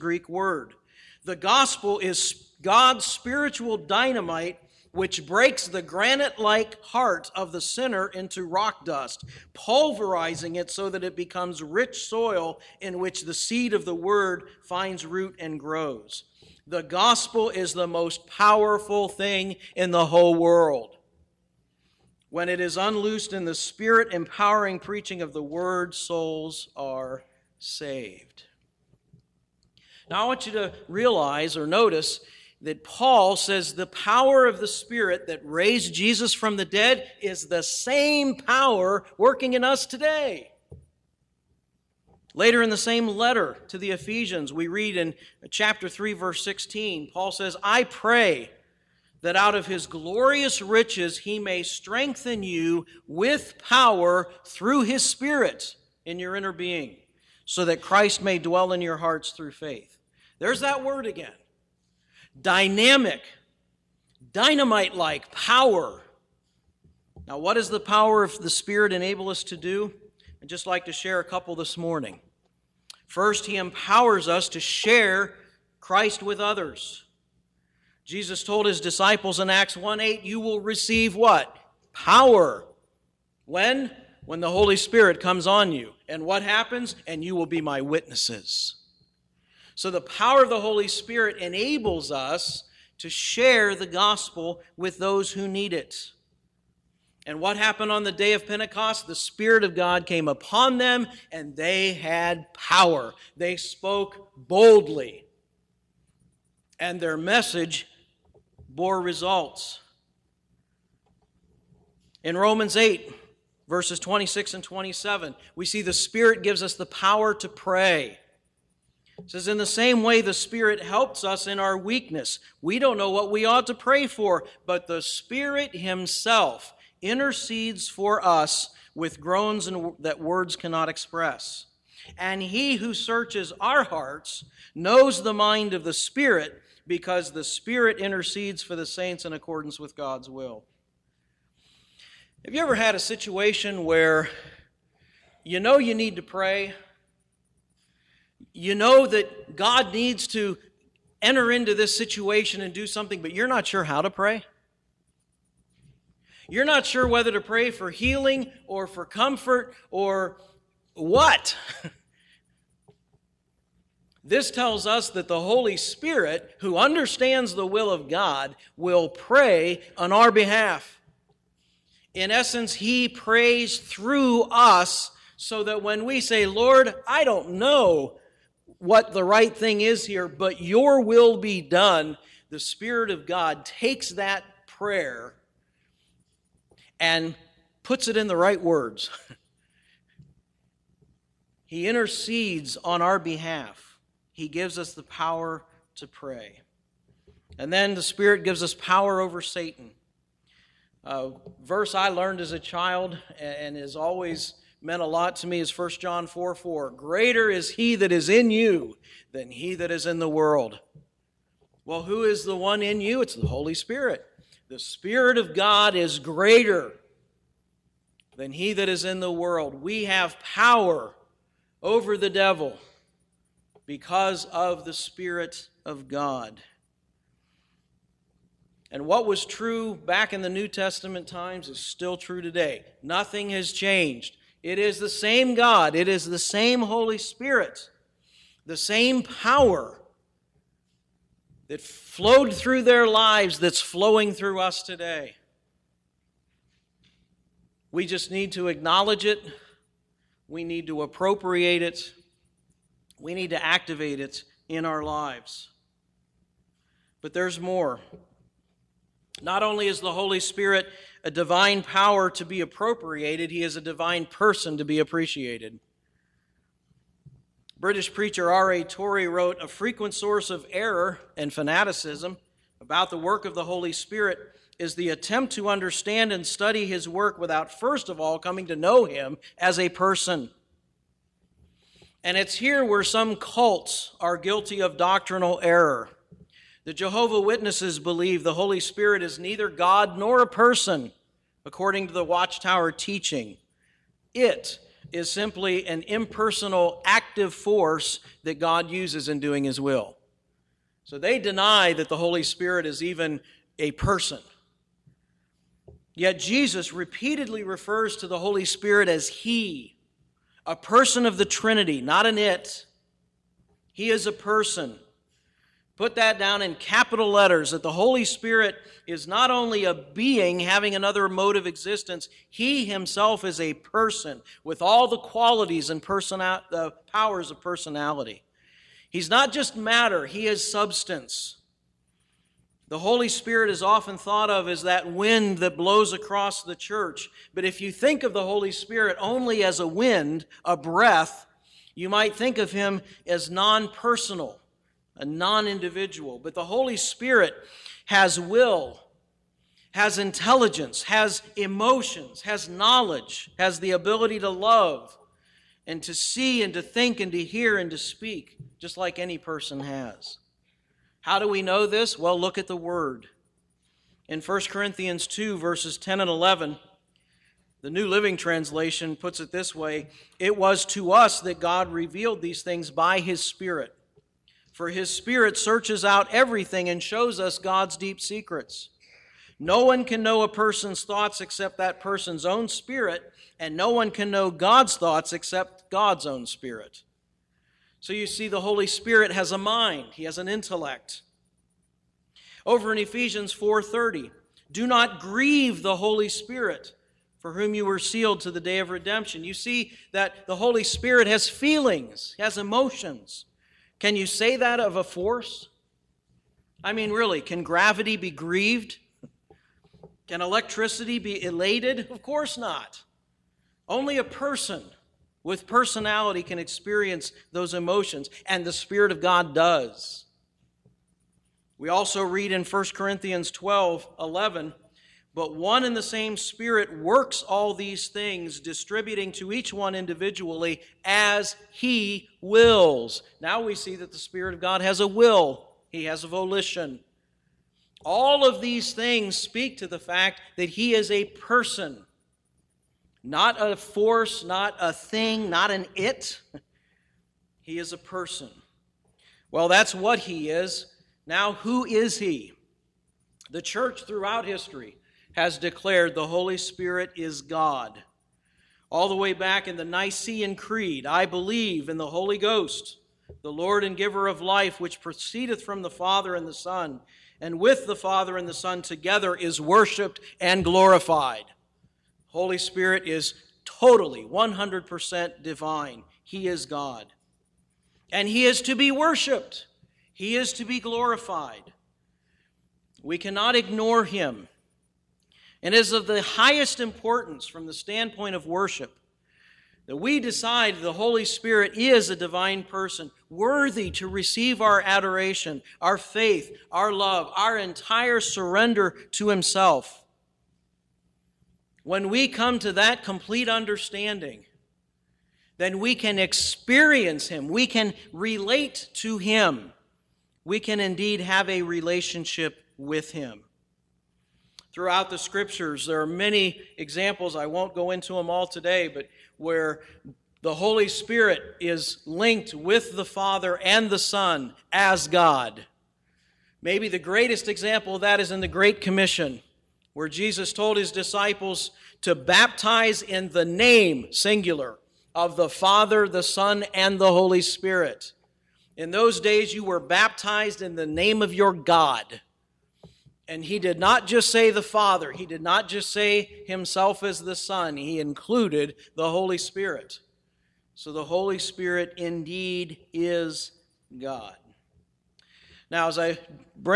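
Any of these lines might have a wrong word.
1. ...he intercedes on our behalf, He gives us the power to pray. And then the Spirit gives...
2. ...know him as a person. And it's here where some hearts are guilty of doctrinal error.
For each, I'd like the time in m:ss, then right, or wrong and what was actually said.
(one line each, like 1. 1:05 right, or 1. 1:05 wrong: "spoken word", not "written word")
1. 3:11 right
2. 4:38 wrong: "cults", not "hearts".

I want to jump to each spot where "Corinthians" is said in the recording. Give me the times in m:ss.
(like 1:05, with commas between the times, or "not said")
6:04, 7:02.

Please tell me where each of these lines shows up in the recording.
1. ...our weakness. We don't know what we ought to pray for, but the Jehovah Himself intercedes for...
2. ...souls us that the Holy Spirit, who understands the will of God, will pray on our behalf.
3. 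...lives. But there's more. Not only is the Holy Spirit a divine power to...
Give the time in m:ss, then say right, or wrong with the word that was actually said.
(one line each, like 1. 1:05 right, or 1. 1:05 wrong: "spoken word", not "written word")
1. 2:01 wrong: "Spirit", not "Jehovah"
2. 2:44 wrong: "tells", not "souls"
3. 4:15 right.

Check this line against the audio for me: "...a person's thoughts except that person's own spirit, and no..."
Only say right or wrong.
right.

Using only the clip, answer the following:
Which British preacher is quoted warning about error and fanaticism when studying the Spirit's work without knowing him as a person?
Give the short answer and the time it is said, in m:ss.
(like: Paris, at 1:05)
R.A. Torrey, at 4:28.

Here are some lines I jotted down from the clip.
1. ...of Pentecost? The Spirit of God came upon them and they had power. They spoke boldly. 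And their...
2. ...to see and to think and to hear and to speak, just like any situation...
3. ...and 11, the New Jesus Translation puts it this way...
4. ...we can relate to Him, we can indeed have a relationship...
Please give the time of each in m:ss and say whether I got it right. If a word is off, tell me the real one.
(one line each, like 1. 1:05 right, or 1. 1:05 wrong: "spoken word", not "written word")
1. 1:38 right
2. 5:56 wrong: "person", not "situation"
3. 6:06 wrong: "Living", not "Jesus"
4. 8:27 right.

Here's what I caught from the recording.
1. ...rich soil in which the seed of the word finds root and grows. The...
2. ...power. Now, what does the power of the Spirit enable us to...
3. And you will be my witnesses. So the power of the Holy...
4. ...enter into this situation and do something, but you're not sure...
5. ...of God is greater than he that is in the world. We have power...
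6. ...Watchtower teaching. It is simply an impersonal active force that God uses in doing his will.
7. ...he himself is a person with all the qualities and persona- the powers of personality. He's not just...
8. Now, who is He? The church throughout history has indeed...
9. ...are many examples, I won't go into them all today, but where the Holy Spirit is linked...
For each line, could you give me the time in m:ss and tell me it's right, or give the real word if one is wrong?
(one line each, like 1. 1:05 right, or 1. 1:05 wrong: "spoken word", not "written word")
1. 0:11 right
2. 1:05 right
3. 1:27 right
4. 2:31 right
5. 3:35 right
6. 4:52 right
7. 5:22 right
8. 7:31 wrong: "declared", not "indeed"
9. 8:35 right.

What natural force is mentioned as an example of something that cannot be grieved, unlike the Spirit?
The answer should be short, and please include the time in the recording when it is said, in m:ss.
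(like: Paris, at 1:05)
Gravity, at 6:47.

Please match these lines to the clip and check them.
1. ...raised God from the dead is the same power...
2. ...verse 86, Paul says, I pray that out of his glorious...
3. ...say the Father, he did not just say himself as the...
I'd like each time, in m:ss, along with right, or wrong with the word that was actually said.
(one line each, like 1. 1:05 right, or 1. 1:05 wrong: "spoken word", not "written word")
1. 0:35 wrong: "Jesus", not "God"
2. 0:46 wrong: "16", not "86"
3. 9:04 right.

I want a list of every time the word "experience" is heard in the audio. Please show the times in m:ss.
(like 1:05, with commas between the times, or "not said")
6:56, 8:26.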